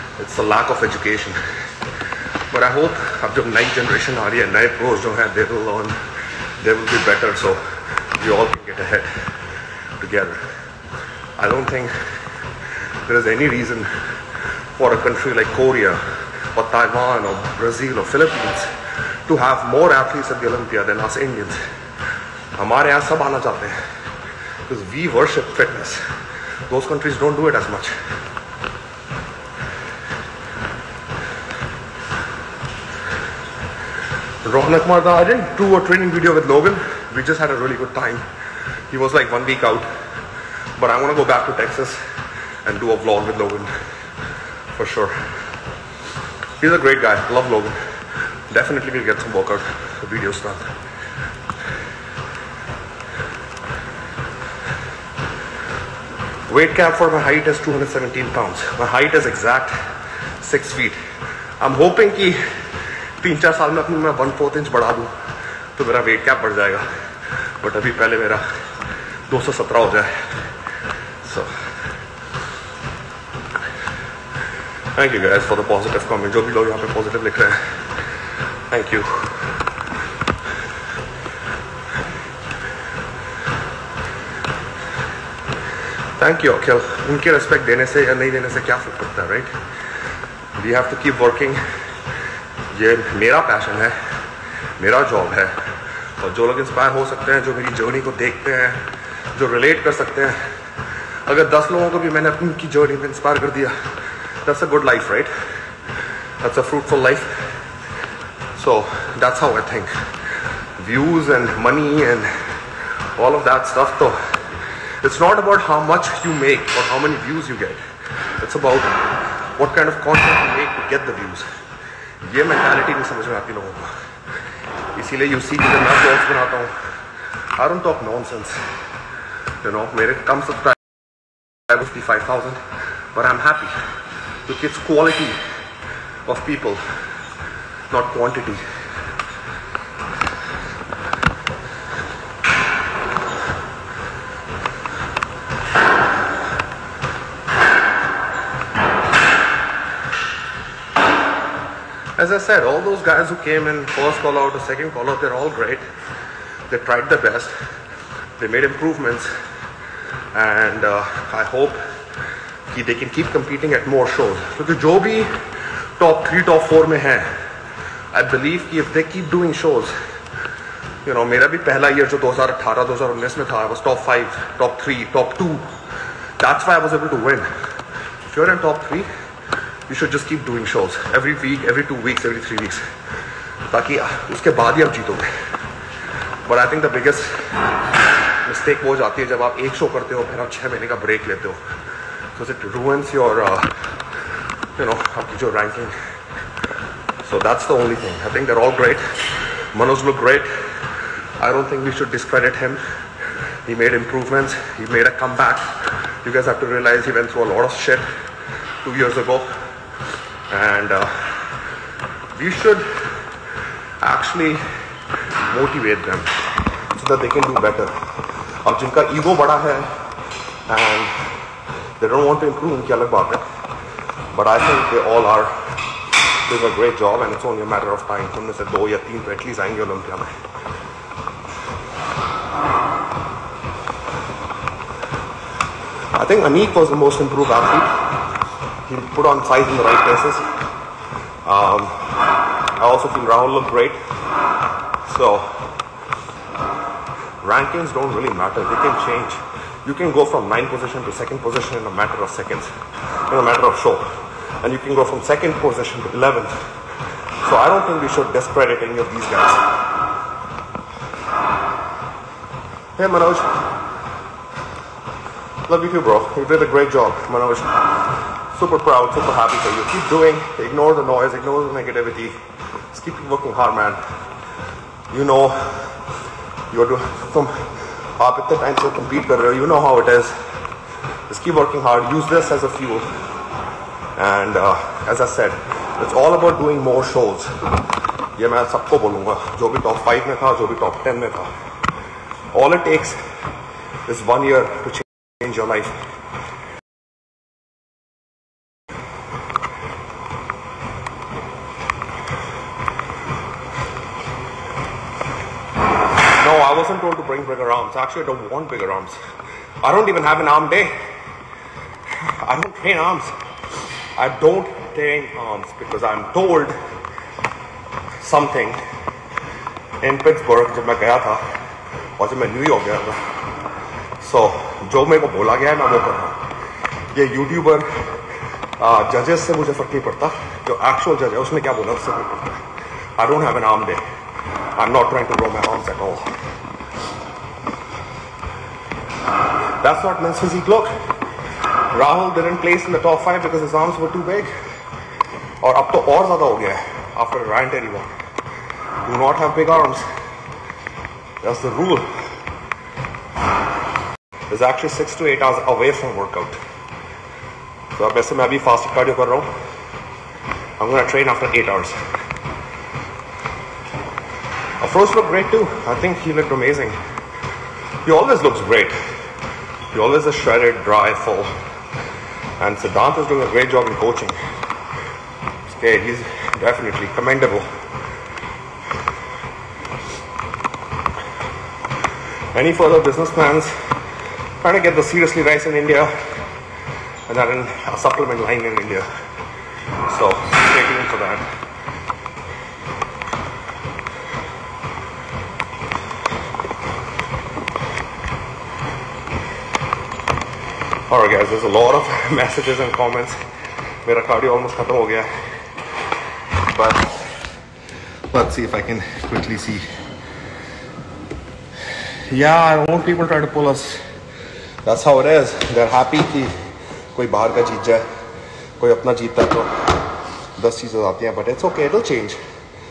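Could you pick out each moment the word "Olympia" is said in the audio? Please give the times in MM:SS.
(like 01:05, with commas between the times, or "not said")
00:20.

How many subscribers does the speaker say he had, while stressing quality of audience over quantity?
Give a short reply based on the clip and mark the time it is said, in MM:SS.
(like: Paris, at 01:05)
5000, at 02:12.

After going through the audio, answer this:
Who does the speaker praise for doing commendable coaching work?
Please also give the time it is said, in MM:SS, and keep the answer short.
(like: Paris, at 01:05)
Siddhant, at 06:12.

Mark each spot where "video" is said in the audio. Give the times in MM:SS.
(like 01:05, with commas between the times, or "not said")
00:36, 00:50.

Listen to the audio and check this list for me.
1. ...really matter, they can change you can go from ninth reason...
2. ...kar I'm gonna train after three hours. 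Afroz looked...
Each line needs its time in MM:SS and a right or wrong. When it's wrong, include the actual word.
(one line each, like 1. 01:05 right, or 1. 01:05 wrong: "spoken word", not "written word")
1. 04:08 wrong: "position", not "reason"
2. 05:59 wrong: "eight", not "three".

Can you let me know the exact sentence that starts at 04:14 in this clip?
And you can go from second position to 11th.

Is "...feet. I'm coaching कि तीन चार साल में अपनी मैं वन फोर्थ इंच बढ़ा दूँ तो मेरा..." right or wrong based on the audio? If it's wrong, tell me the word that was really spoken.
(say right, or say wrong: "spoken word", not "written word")
wrong: "hoping", not "coaching".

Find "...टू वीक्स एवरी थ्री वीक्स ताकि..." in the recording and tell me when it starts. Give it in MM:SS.
03:01.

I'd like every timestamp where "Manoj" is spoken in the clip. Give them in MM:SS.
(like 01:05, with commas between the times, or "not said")
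03:19, 04:23, 04:27.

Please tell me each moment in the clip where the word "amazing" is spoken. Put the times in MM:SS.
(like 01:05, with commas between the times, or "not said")
06:06.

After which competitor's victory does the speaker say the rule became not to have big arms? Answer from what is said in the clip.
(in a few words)
Ryan Terry.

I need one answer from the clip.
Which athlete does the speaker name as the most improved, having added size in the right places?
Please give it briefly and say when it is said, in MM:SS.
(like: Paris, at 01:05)
Anik, at 03:56.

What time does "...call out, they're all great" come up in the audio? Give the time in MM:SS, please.
02:34.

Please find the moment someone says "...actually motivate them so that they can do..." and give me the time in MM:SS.
03:33.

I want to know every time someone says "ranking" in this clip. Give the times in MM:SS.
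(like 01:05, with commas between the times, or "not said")
03:15, 04:07.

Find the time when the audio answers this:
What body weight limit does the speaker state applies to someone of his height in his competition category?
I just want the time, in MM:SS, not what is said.
00:57.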